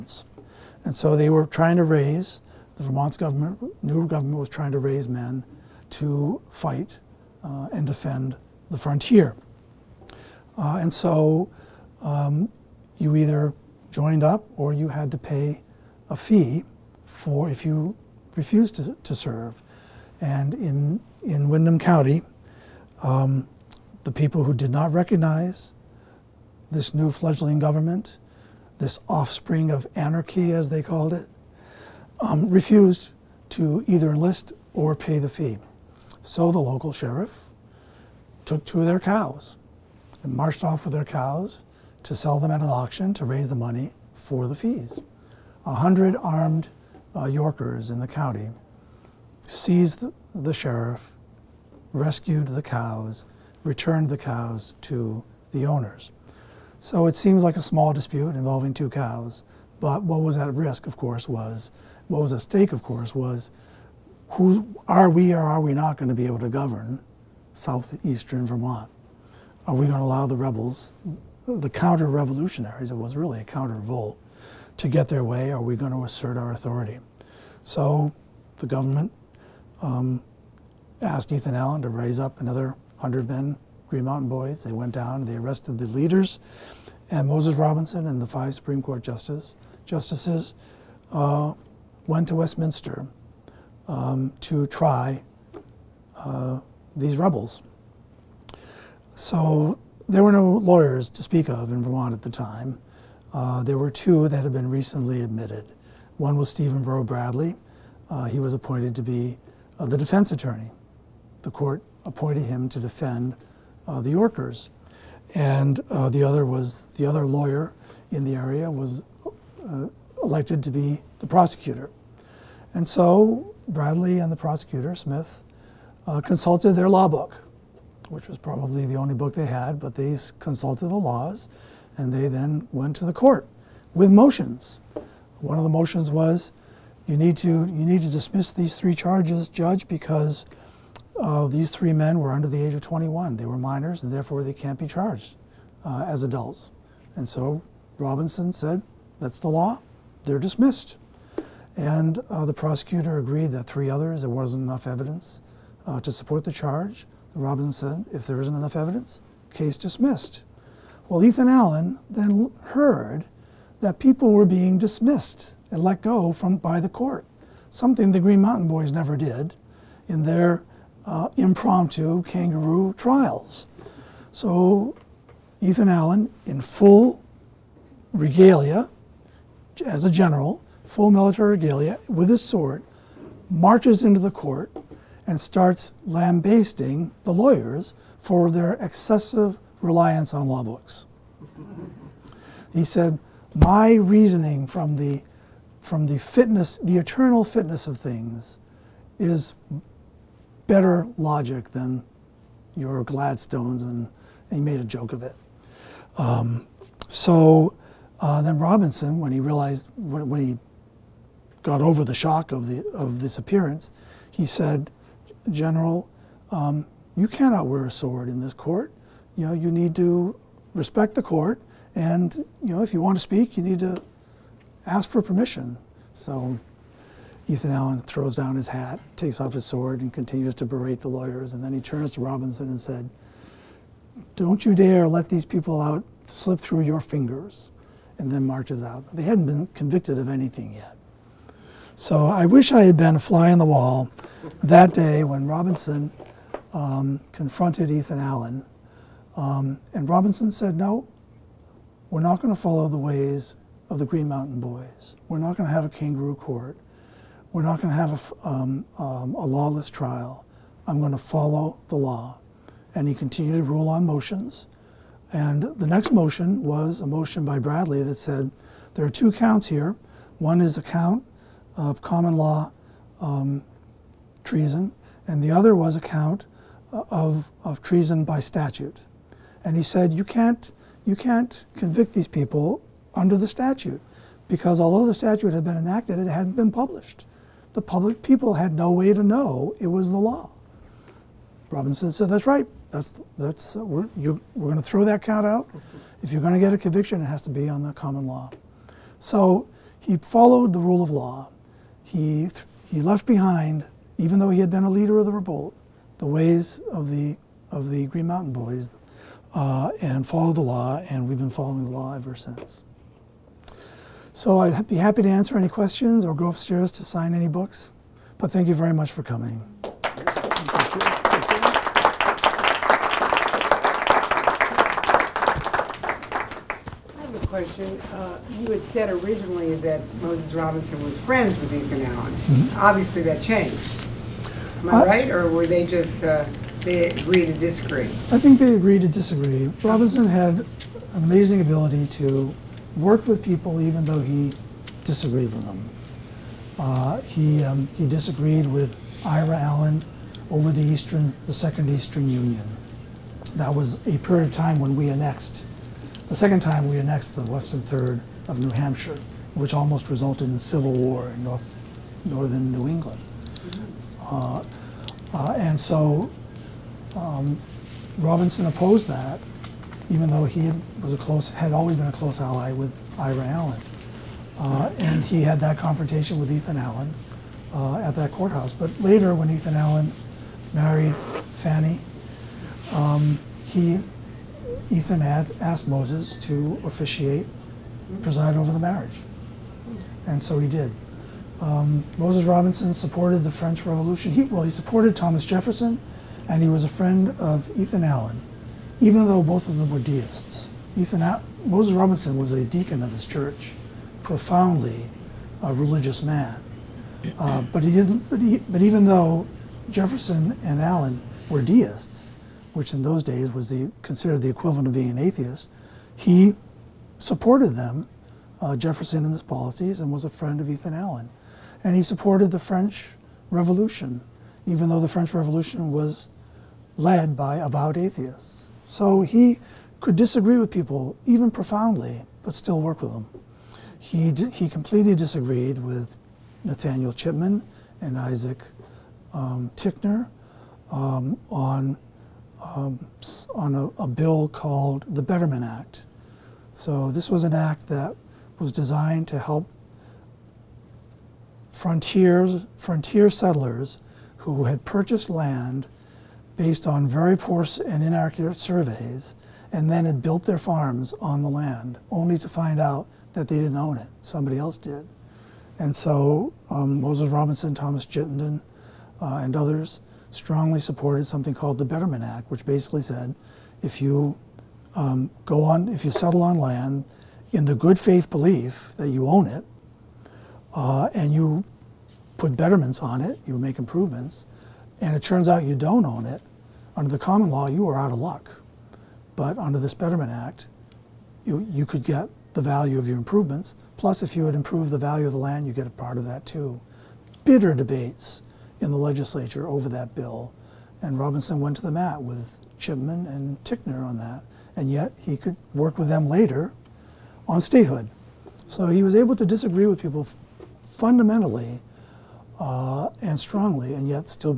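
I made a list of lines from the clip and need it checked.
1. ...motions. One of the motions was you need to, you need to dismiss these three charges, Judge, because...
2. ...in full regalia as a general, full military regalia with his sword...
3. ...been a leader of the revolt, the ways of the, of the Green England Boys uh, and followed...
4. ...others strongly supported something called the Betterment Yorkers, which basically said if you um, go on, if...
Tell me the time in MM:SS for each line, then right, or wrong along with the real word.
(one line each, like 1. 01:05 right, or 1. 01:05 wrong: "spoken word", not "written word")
1. 02:14 right
2. 02:56 right
3. 05:04 wrong: "Mountain", not "England"
4. 07:49 wrong: "Act", not "Yorkers".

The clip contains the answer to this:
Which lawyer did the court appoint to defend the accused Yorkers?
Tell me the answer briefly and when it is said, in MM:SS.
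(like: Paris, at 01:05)
Stephen Row Bradley, at 01:46.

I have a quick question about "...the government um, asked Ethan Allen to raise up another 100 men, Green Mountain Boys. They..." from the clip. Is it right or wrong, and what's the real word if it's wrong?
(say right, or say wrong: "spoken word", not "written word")
right.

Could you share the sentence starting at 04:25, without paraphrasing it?
And the next motion was a motion by Bradley that said, there are two counts here.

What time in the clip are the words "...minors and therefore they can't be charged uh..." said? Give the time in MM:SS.
02:23.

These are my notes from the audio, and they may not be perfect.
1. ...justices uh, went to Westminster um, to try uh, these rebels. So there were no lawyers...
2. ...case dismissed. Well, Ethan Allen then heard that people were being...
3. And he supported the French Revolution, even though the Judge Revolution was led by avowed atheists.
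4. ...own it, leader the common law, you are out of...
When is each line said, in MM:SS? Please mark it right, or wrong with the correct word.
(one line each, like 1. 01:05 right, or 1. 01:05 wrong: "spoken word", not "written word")
1. 01:29 right
2. 02:39 right
3. 07:01 wrong: "French", not "Judge"
4. 08:06 wrong: "under", not "leader".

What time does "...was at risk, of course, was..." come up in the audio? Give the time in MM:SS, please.
01:00.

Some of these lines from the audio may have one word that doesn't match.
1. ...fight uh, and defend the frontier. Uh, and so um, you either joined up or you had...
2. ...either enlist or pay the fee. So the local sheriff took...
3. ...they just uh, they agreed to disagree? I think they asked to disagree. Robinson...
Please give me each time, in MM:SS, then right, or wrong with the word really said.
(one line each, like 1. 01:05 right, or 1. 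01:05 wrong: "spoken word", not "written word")
1. 00:06 right
2. 00:33 right
3. 05:35 wrong: "agreed", not "asked".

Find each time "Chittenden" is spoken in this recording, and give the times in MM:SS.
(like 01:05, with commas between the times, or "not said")
07:48.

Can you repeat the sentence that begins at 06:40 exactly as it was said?
Ethan Moses Robinson was a deacon of his church, profoundly a religious man.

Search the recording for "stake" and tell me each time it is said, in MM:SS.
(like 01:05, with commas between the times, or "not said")
01:02.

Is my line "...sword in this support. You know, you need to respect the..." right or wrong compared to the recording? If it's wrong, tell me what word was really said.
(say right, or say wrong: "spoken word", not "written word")
wrong: "court", not "support".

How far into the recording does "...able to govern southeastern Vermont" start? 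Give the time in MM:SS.
01:06.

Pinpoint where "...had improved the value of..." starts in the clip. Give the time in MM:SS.
08:14.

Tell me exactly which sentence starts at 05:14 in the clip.
So I'd be happy to answer any questions or go upstairs to sign any books, but thank you very much for coming.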